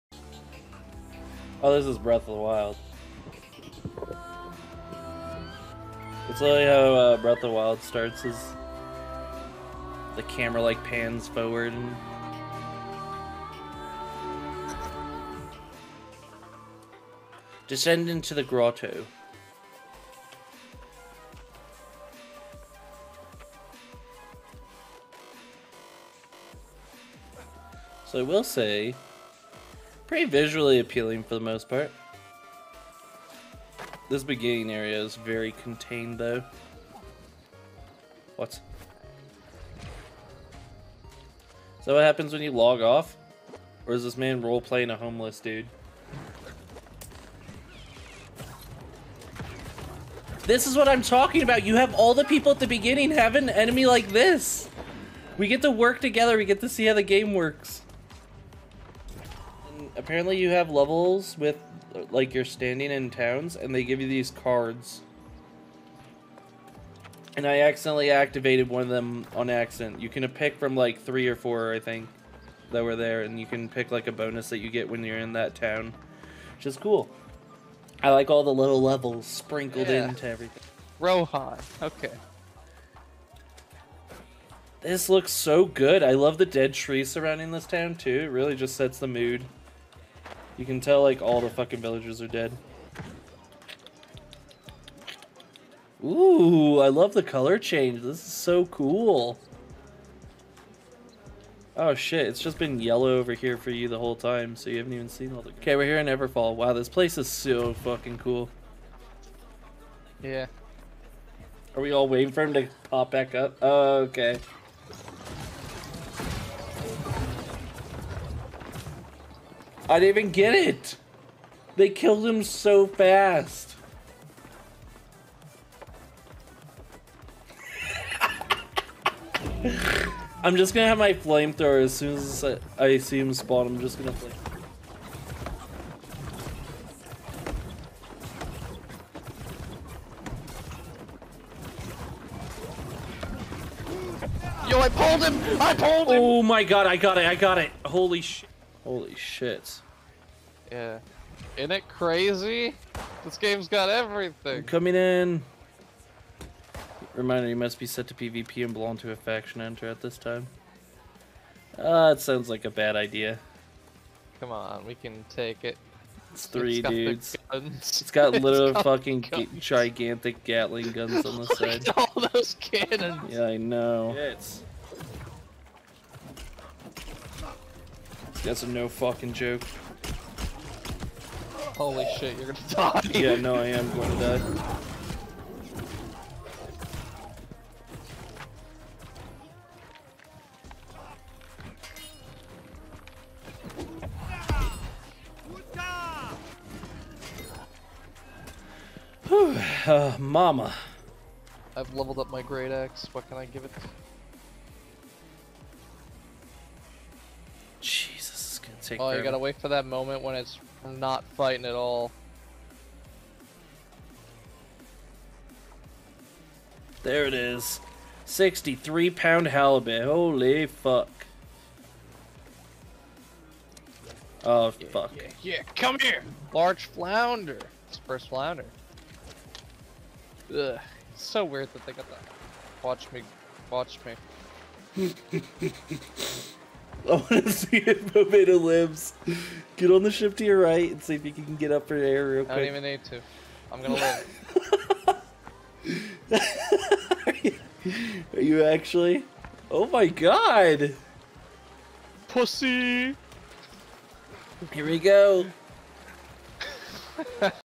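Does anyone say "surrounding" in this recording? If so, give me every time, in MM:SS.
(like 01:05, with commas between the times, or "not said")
01:27.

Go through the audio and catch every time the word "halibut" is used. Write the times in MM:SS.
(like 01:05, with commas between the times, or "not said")
03:39.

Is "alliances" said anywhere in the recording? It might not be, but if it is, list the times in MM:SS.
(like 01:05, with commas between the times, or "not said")
not said.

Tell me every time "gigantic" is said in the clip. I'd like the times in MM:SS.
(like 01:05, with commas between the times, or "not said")
02:49.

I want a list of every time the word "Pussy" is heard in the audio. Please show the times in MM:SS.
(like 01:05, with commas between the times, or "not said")
04:12.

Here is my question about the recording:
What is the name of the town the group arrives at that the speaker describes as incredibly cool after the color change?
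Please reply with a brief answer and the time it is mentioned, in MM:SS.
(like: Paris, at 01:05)
Everfall, at 01:46.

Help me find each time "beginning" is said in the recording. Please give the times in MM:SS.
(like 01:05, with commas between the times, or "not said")
00:34, 00:52.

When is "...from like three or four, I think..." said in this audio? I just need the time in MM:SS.
01:10.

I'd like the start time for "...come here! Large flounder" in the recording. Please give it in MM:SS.
03:45.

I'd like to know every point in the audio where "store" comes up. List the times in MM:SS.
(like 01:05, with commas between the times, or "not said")
not said.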